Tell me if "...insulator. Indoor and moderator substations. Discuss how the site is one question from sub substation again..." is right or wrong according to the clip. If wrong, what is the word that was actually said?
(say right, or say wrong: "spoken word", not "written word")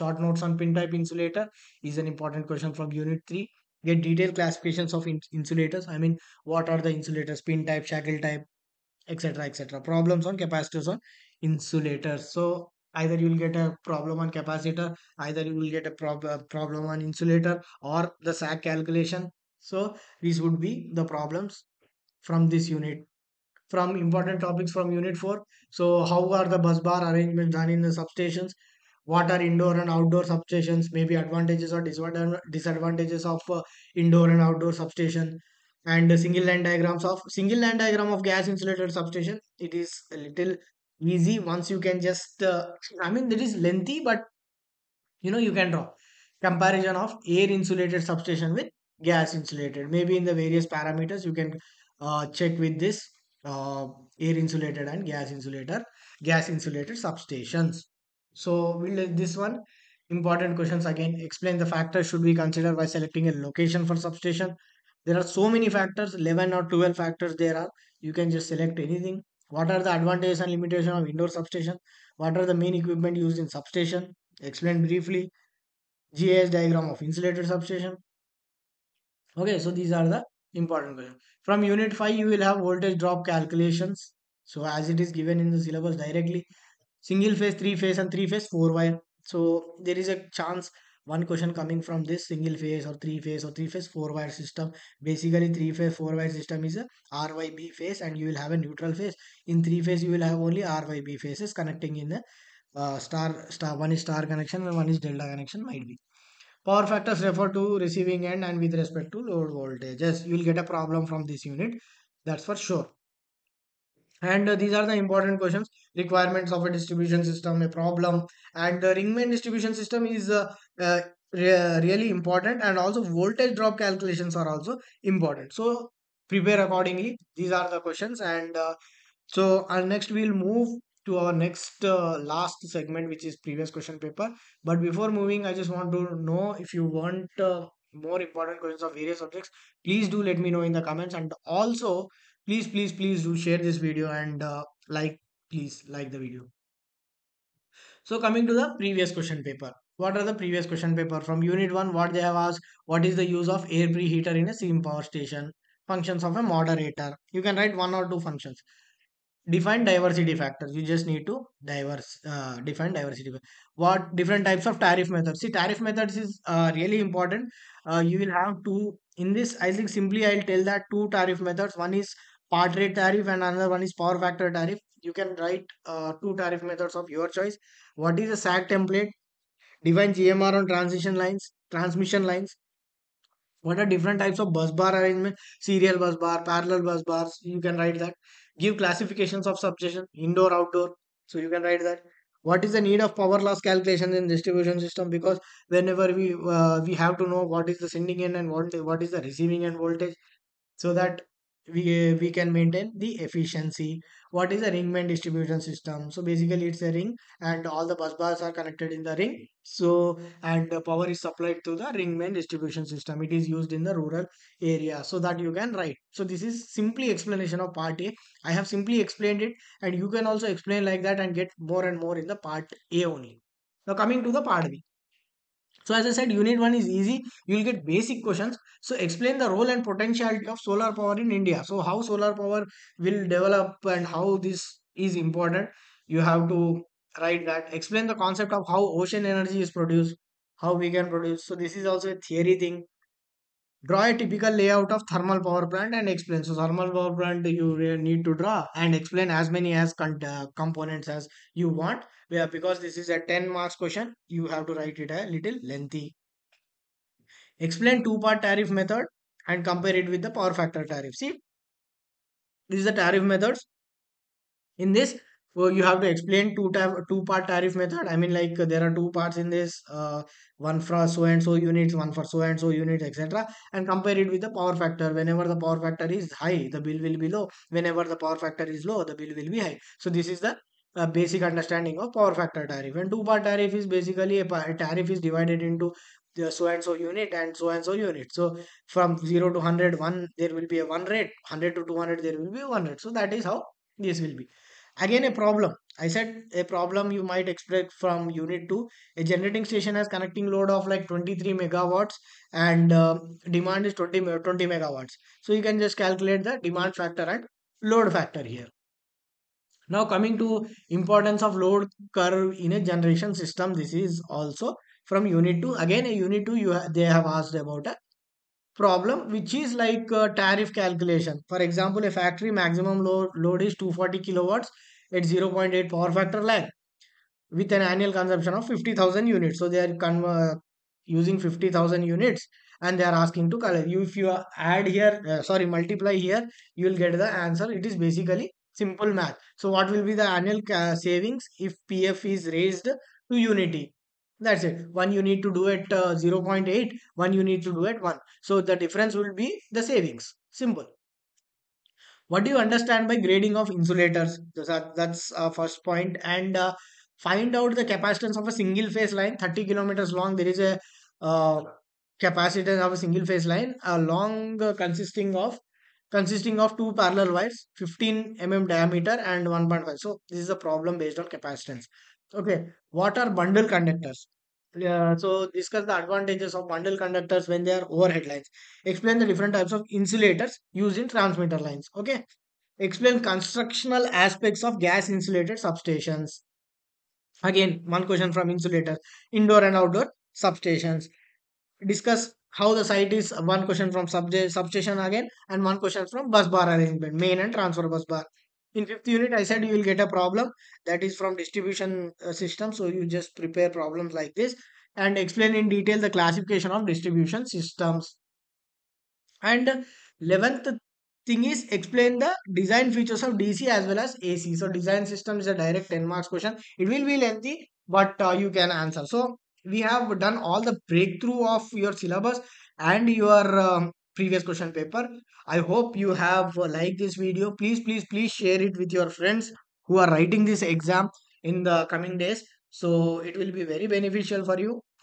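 wrong: "outdoor", not "moderator".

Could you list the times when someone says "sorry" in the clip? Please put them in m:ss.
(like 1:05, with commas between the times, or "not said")
5:35.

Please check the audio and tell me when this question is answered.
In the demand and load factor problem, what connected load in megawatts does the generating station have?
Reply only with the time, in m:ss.
5:01.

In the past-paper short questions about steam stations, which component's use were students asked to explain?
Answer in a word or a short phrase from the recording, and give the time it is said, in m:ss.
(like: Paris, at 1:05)
Air preheater, at 2:33.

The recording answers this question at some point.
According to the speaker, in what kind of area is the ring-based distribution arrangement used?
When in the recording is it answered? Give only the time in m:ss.
3:33.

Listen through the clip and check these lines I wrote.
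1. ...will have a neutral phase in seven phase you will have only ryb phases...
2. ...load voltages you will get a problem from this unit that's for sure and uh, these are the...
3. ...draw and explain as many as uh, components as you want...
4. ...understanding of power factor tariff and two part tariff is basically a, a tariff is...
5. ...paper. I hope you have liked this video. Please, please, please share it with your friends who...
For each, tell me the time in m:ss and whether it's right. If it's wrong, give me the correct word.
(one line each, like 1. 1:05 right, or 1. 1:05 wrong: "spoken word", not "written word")
1. 1:38 wrong: "three", not "seven"
2. 1:49 right
3. 4:08 right
4. 4:41 right
5. 7:04 right.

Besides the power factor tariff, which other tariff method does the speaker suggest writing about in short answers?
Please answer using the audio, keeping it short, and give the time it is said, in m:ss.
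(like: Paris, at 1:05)
Part rate tariff, at 2:52.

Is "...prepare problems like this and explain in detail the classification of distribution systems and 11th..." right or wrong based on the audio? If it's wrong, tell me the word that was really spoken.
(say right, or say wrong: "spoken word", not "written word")
right.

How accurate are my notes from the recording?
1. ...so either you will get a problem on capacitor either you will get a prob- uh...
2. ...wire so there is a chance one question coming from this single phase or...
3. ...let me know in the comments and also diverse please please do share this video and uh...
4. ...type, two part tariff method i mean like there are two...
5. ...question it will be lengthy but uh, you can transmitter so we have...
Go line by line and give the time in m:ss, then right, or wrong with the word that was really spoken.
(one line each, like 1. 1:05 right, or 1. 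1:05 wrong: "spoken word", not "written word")
1. 0:12 right
2. 1:28 right
3. 2:20 wrong: "please", not "diverse"
4. 4:26 right
5. 6:56 wrong: "answer", not "transmitter".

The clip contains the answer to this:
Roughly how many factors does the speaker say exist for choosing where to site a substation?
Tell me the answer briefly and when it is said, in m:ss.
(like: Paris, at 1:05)
11 or 12, at 1:06.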